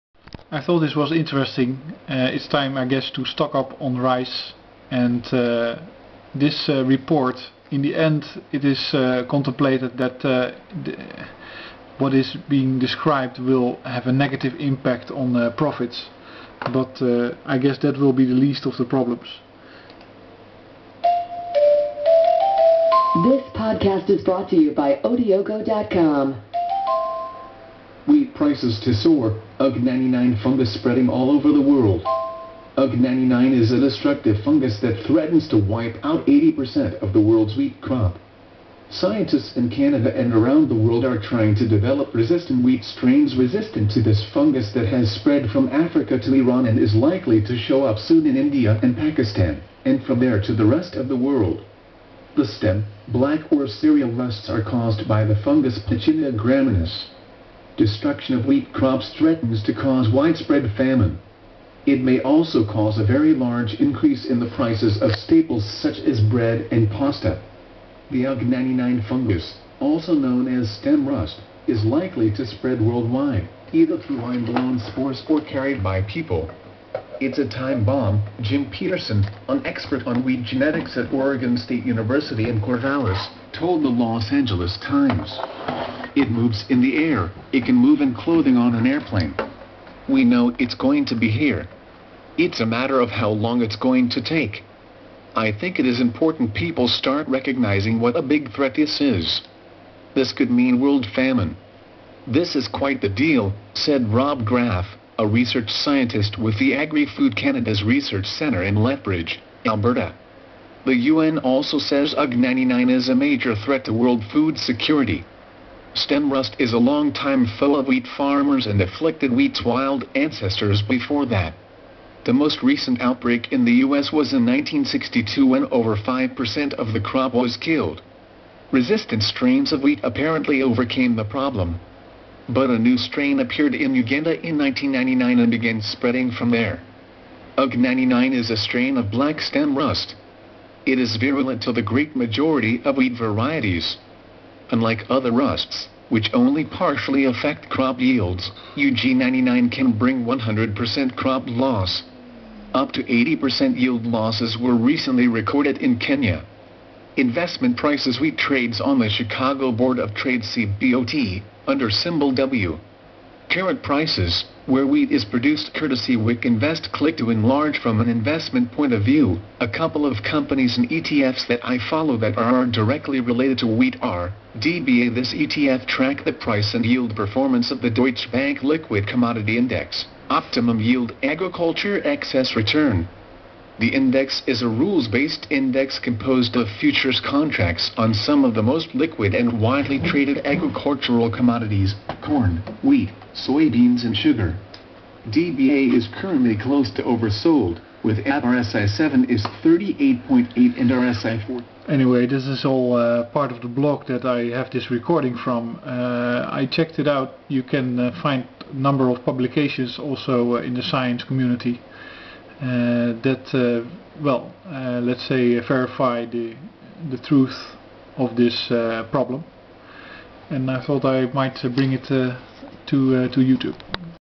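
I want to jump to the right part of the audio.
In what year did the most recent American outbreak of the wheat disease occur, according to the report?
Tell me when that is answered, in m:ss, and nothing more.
2:04.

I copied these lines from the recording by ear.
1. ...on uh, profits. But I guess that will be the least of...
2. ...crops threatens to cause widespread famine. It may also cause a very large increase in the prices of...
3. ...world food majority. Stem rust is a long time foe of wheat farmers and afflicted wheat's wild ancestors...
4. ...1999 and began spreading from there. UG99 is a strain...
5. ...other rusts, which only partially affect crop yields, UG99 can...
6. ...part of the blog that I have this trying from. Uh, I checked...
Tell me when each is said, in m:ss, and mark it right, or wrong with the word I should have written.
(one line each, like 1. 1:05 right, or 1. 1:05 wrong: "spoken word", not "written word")
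1. 0:15 right
2. 0:58 right
3. 1:53 wrong: "security", not "majority"
4. 2:14 right
5. 2:25 right
6. 3:23 wrong: "recording", not "trying".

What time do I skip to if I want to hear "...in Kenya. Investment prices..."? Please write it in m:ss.
2:35.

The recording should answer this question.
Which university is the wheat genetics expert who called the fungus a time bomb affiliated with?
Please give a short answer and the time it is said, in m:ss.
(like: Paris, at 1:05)
Oregon State University, at 1:21.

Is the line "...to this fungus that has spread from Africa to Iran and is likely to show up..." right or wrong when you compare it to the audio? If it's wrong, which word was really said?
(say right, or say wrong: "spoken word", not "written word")
right.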